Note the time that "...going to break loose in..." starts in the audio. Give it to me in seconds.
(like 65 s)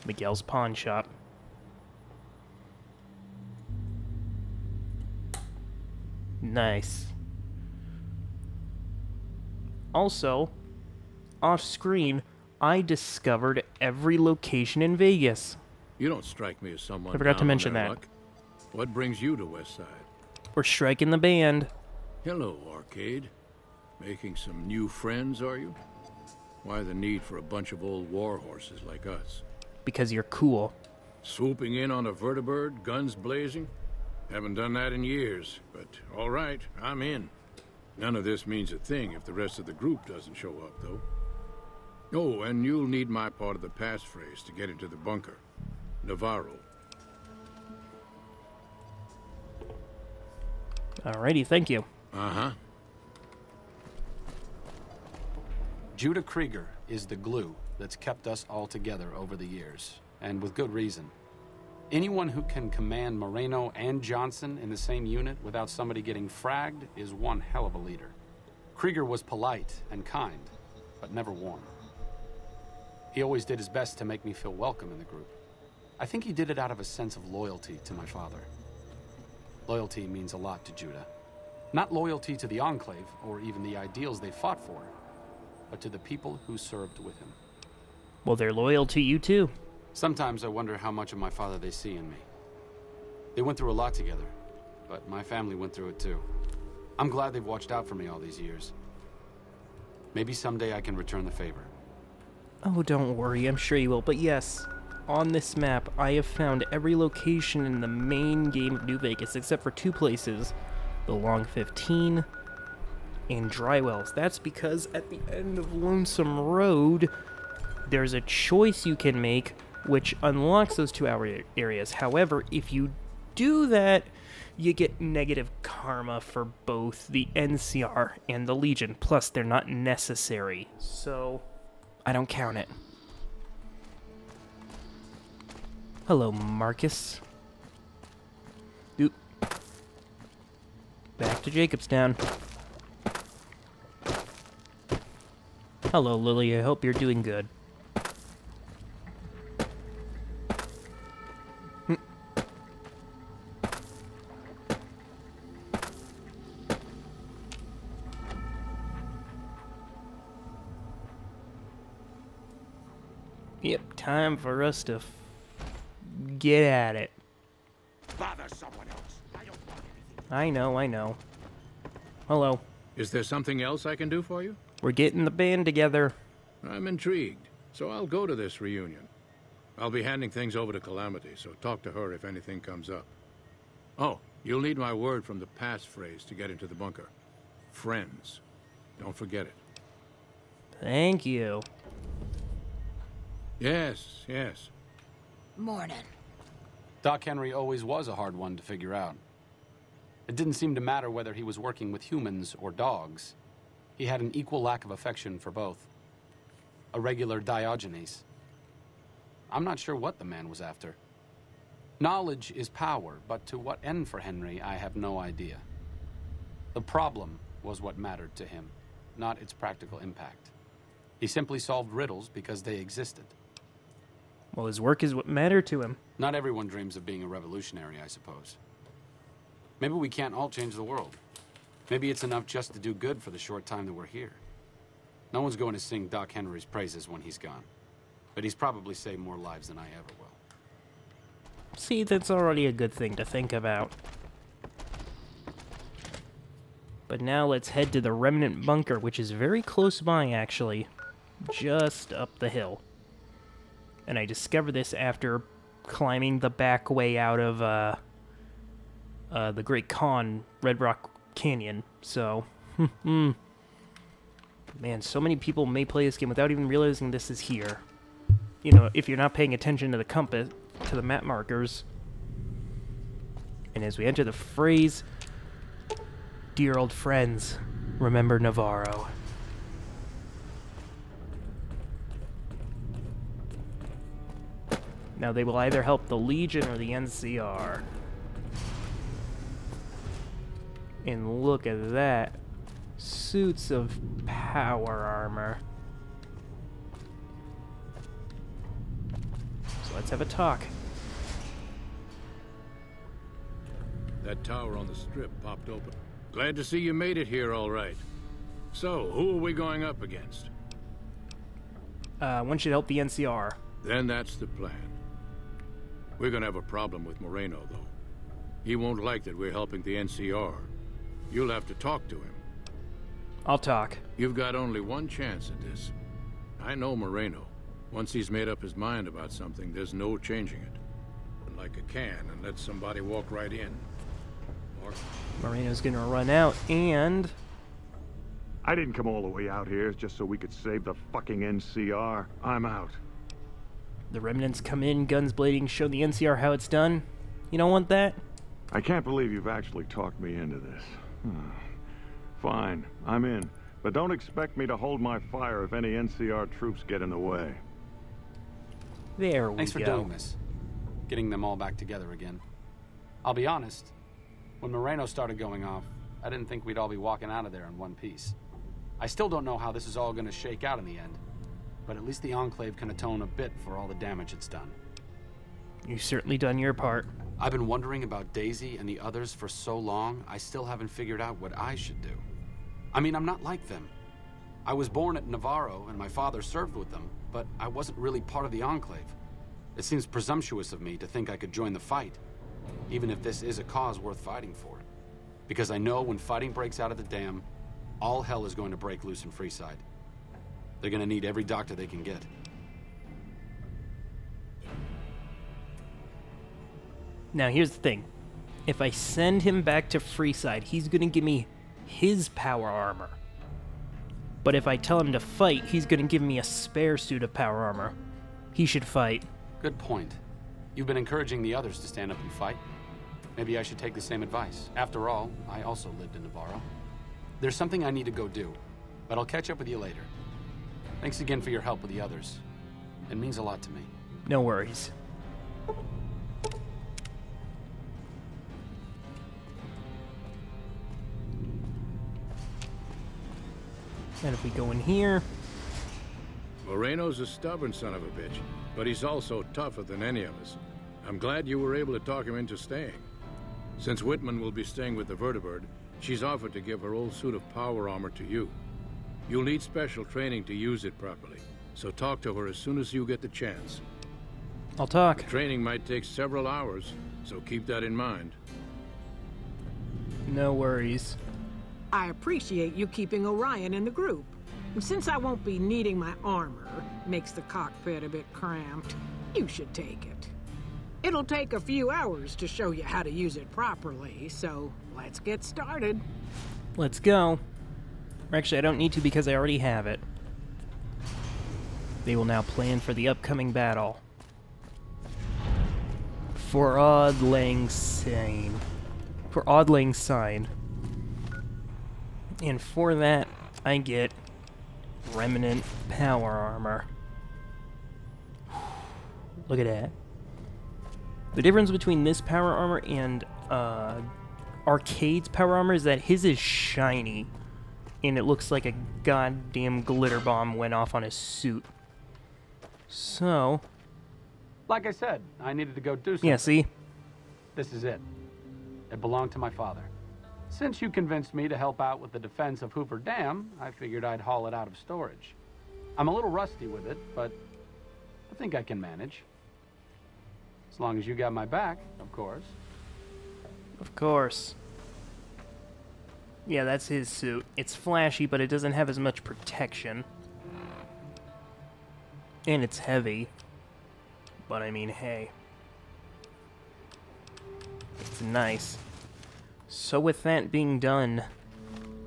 398 s.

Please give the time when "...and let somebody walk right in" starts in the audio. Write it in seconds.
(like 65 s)
332 s.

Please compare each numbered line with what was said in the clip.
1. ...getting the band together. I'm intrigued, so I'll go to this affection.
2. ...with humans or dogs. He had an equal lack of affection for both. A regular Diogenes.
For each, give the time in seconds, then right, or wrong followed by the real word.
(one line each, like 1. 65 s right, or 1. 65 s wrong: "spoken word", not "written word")
1. 174 s wrong: "reunion", not "affection"
2. 201 s right.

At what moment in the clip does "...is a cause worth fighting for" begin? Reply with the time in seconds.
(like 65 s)
393 s.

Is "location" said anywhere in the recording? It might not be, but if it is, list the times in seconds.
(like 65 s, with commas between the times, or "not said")
14 s, 106 s.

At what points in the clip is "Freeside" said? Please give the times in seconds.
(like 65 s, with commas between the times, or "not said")
399 s, 409 s.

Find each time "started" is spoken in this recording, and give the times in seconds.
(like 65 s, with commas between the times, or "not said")
365 s, 485 s.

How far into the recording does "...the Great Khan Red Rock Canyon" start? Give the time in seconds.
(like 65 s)
259 s.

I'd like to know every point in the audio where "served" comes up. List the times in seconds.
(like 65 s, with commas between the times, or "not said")
86 s, 386 s.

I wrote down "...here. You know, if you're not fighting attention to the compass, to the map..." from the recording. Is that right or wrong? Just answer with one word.
wrong.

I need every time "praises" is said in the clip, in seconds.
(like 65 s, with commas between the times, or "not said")
236 s.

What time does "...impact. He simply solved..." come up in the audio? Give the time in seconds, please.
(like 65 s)
219 s.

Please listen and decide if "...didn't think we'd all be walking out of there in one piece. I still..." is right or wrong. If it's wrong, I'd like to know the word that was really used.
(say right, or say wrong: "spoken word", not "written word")
right.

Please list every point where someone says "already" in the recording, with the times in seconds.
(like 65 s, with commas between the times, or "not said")
242 s, 489 s.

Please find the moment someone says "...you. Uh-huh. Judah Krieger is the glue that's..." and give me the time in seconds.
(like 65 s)
51 s.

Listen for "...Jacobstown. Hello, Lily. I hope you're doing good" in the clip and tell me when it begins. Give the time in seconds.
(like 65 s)
141 s.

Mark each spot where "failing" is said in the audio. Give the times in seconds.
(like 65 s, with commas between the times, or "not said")
not said.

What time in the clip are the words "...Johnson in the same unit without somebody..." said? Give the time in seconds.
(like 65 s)
64 s.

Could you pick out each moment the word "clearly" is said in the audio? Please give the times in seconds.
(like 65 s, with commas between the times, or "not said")
not said.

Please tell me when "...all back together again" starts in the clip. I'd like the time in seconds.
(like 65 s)
361 s.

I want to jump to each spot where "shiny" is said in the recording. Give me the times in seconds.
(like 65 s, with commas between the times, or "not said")
516 s.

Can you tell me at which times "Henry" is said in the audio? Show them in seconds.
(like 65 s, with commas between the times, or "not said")
197 s, 214 s, 236 s.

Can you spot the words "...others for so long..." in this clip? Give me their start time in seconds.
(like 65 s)
379 s.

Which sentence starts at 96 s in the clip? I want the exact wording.
I'm glad they've watched out for me all these years.